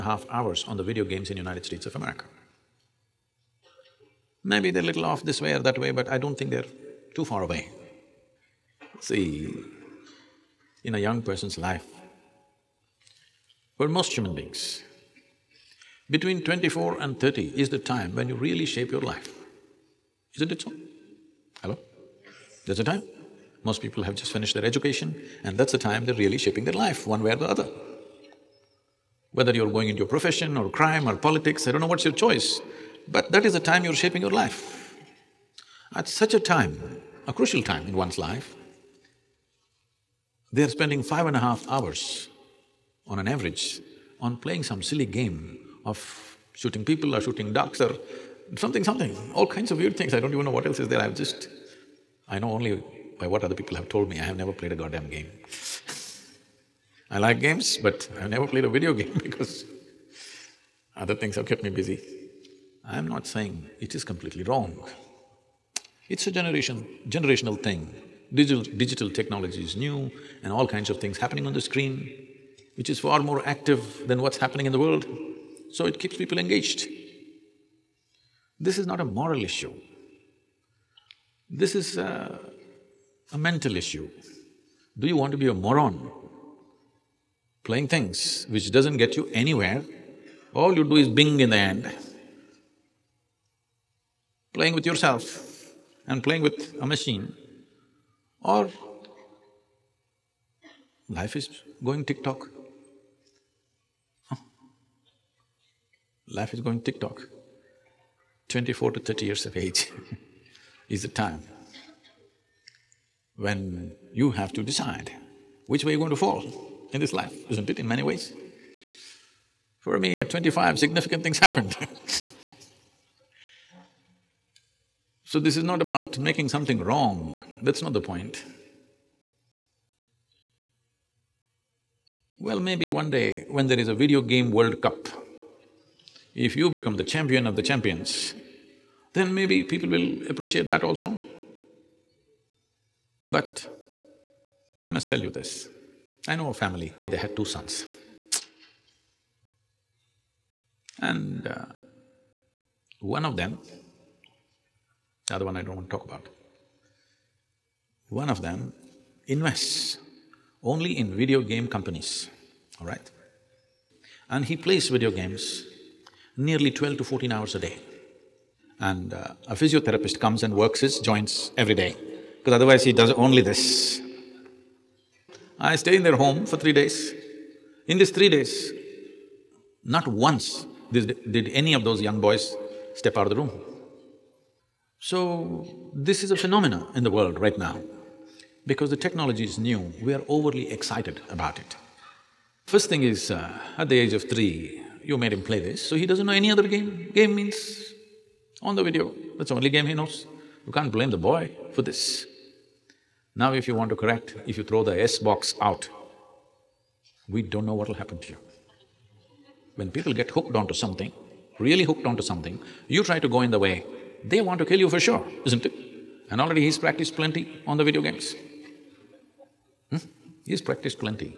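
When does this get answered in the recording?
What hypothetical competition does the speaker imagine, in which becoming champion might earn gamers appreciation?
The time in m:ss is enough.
2:13.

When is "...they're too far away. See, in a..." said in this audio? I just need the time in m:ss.
0:06.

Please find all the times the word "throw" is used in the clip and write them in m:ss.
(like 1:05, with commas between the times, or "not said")
3:24.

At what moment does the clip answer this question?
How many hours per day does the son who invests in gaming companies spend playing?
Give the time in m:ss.
2:46.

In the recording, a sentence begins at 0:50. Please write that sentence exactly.
I don't even know what else is there.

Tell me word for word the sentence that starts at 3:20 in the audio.
You can't blame the boy for this.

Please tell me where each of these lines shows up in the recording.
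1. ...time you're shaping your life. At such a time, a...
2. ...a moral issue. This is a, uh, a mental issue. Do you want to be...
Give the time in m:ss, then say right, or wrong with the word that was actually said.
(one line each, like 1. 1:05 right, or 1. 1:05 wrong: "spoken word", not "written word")
1. 0:33 right
2. 1:18 right.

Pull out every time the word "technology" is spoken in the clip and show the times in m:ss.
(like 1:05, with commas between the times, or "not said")
1:09, 3:08.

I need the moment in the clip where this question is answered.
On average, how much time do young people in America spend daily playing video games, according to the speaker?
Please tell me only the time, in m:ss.
0:41.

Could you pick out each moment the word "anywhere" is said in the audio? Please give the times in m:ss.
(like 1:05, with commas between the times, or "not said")
1:29.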